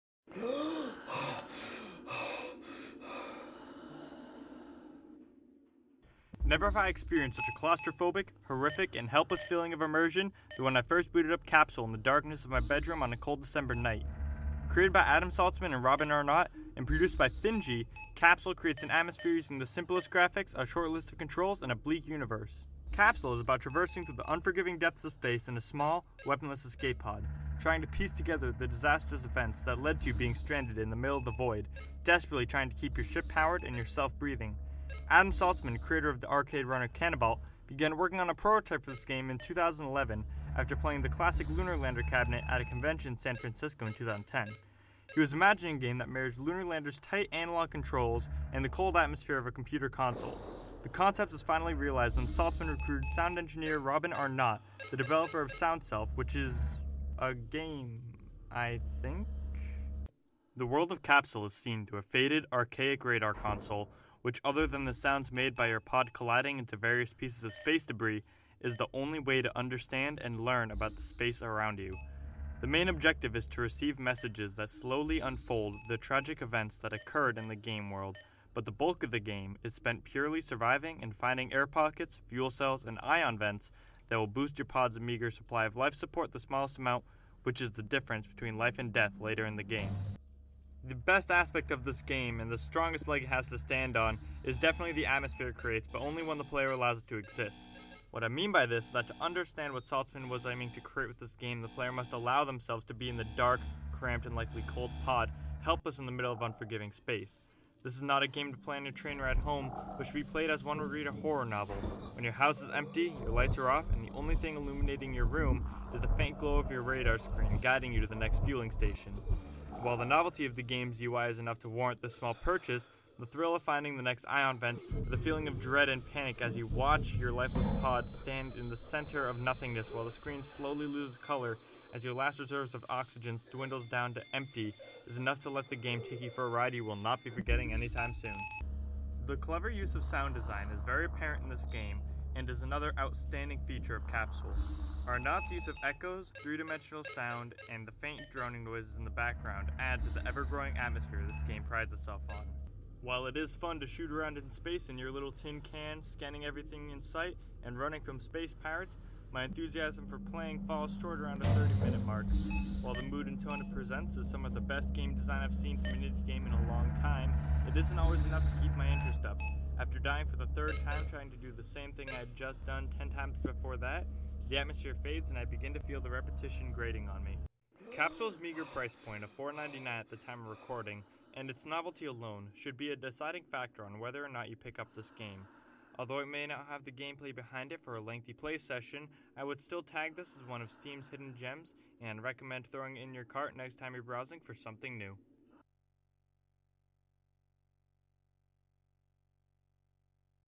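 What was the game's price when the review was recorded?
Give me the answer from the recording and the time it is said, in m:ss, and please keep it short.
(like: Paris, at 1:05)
$4.99, at 2:59.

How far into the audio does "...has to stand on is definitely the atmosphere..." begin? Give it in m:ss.
1:33.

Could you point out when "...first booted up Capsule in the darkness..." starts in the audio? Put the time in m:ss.
0:10.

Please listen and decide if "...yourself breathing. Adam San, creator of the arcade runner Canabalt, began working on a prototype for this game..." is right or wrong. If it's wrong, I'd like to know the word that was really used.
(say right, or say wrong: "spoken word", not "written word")
wrong: "Saltsman", not "San".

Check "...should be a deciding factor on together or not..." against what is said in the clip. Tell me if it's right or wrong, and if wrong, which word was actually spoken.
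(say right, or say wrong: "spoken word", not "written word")
wrong: "whether", not "together".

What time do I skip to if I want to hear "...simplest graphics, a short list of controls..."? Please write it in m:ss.
0:19.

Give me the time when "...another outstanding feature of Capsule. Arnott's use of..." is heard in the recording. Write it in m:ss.
2:22.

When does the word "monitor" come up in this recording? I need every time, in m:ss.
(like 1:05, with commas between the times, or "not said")
not said.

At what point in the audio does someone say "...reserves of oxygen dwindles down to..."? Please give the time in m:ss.
2:12.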